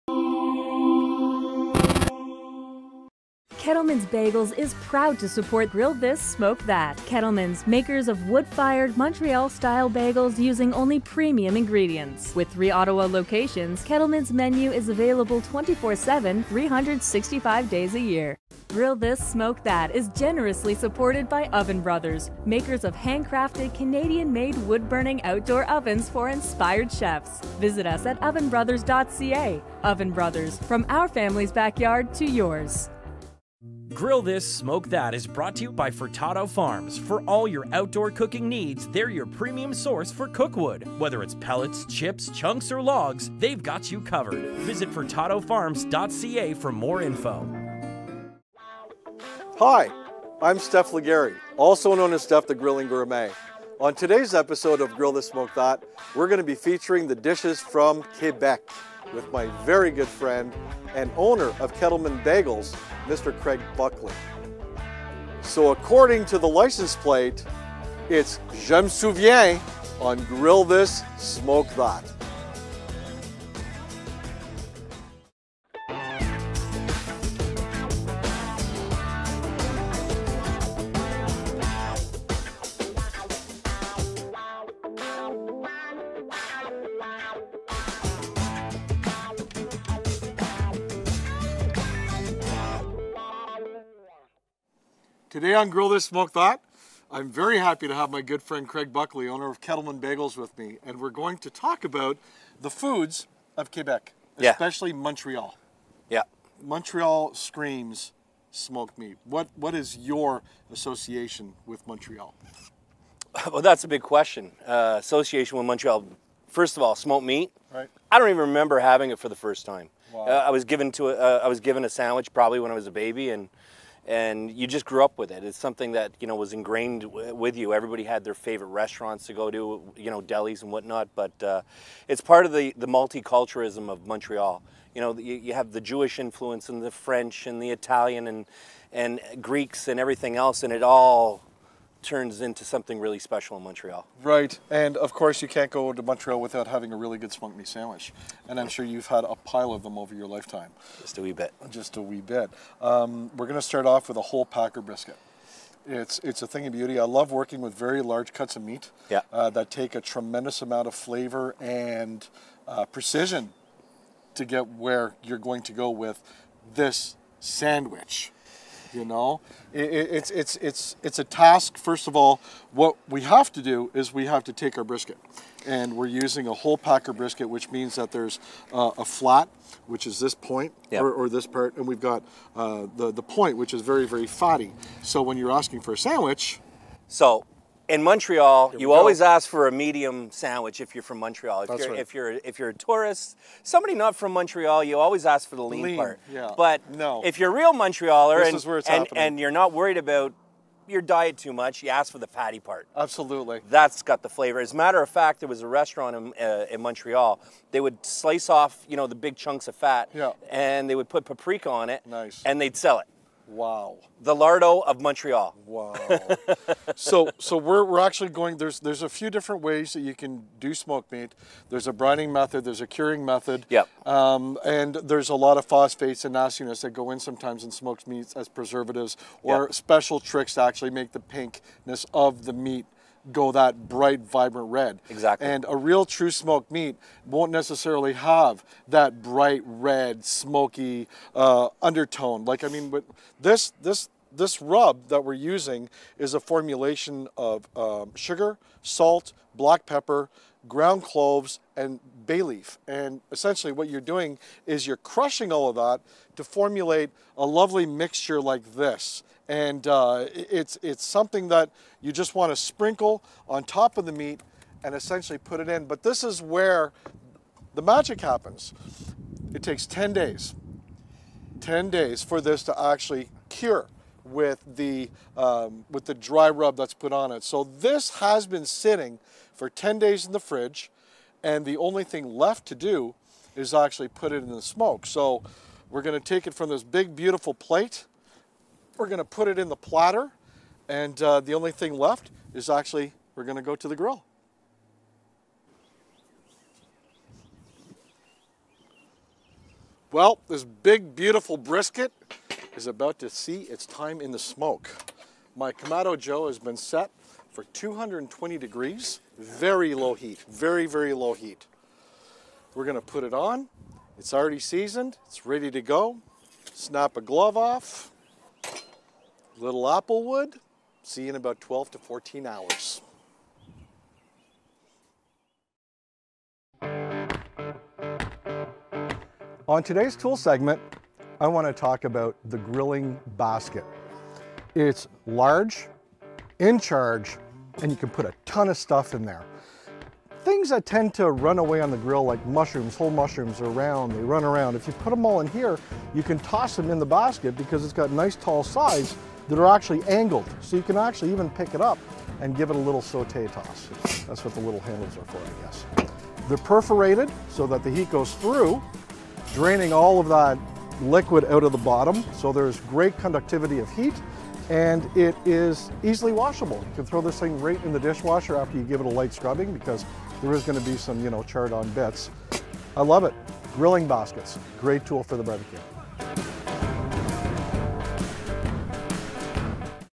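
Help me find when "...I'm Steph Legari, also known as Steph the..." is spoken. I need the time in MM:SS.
00:50.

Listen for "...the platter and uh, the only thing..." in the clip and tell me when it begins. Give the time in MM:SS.
04:49.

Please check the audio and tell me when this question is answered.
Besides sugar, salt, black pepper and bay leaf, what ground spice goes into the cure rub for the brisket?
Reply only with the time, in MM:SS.
04:10.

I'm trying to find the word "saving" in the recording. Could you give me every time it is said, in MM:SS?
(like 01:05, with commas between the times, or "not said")
not said.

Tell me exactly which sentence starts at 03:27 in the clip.
They would slice off, you know, the big chunks of fat, yeah.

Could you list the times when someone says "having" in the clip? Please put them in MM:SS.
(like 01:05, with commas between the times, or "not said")
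01:58, 02:26.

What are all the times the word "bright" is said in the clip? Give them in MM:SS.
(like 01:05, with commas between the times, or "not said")
03:53, 03:59.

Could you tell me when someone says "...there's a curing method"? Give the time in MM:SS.
03:42.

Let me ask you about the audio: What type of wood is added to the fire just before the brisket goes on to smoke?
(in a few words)
Apple wood.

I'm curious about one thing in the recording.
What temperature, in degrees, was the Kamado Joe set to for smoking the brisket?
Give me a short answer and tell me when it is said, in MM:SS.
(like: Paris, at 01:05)
220, at 05:07.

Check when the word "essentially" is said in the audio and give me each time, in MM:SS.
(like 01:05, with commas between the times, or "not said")
04:13, 04:24.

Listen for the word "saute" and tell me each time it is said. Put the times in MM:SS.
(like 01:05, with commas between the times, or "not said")
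05:53.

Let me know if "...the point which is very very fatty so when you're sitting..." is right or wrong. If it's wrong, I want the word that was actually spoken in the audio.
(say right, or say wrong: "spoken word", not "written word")
wrong: "asking", not "sitting".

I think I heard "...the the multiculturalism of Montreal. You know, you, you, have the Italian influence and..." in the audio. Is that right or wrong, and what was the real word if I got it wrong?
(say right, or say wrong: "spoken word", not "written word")
wrong: "Jewish", not "Italian".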